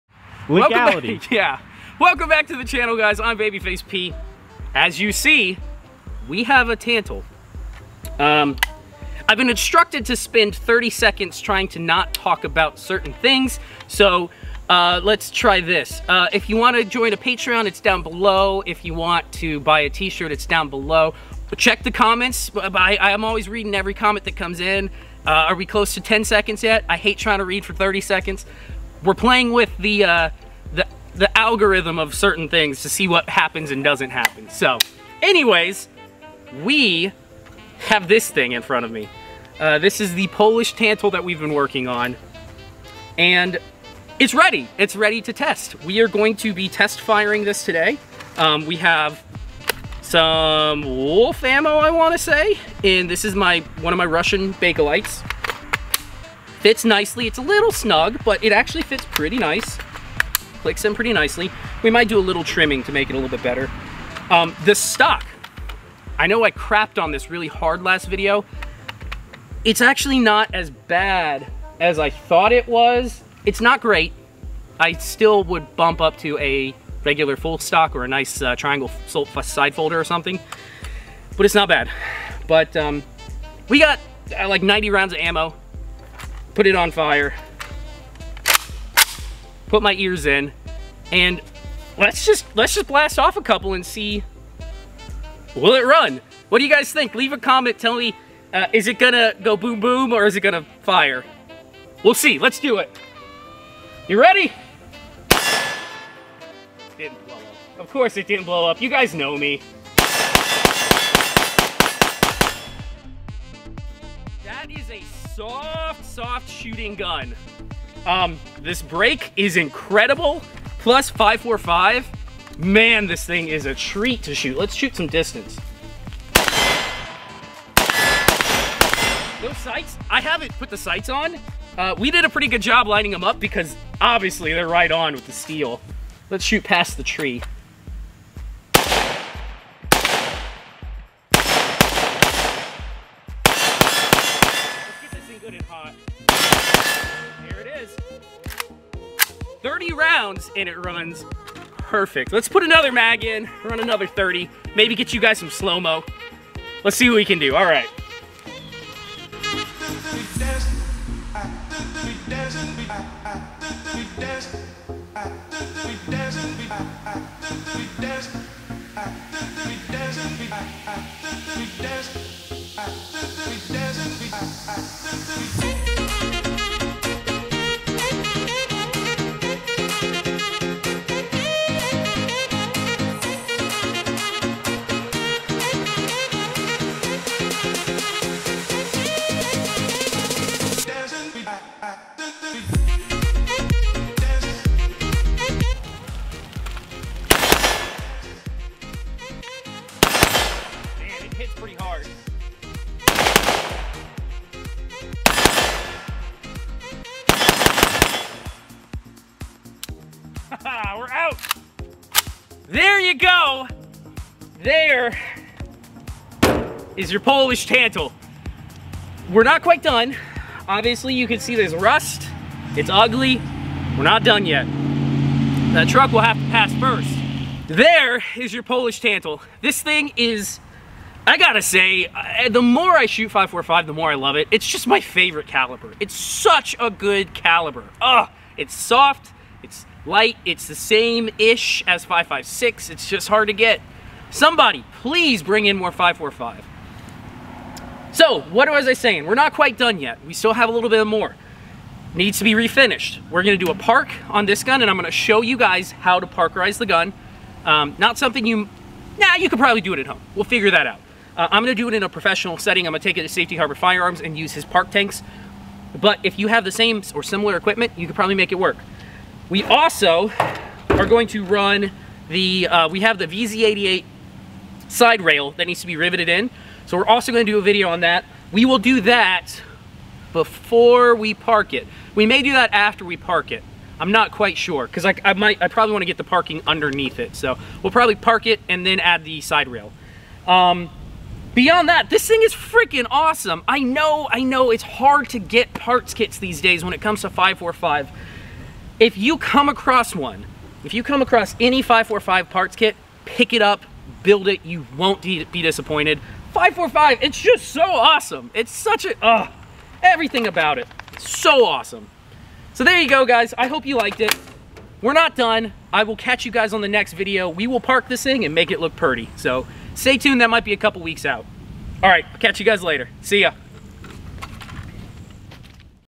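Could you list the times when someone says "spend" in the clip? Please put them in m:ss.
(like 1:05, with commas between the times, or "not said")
0:10.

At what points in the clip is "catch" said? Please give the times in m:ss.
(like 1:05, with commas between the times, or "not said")
5:16, 5:22.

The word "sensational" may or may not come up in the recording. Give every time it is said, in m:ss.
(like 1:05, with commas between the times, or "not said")
not said.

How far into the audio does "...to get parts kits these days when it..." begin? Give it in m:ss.
4:55.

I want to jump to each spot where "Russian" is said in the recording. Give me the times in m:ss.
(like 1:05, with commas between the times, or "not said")
0:54.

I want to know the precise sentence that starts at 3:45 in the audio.
That truck will have to pass first.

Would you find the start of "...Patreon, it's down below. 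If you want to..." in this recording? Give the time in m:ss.
0:17.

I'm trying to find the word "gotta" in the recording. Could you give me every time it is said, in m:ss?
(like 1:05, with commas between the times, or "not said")
3:51.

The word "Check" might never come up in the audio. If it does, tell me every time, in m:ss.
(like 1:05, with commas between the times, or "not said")
0:21.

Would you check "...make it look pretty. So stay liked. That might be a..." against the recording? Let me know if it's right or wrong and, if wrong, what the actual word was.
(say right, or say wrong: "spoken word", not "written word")
wrong: "tuned", not "liked".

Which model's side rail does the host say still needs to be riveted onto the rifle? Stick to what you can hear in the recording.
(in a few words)
VZ88.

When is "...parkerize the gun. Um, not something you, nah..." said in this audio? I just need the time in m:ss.
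4:16.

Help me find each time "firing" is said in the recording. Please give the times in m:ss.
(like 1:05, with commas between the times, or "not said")
0:47.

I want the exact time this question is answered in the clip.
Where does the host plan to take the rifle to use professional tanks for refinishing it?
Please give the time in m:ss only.
4:23.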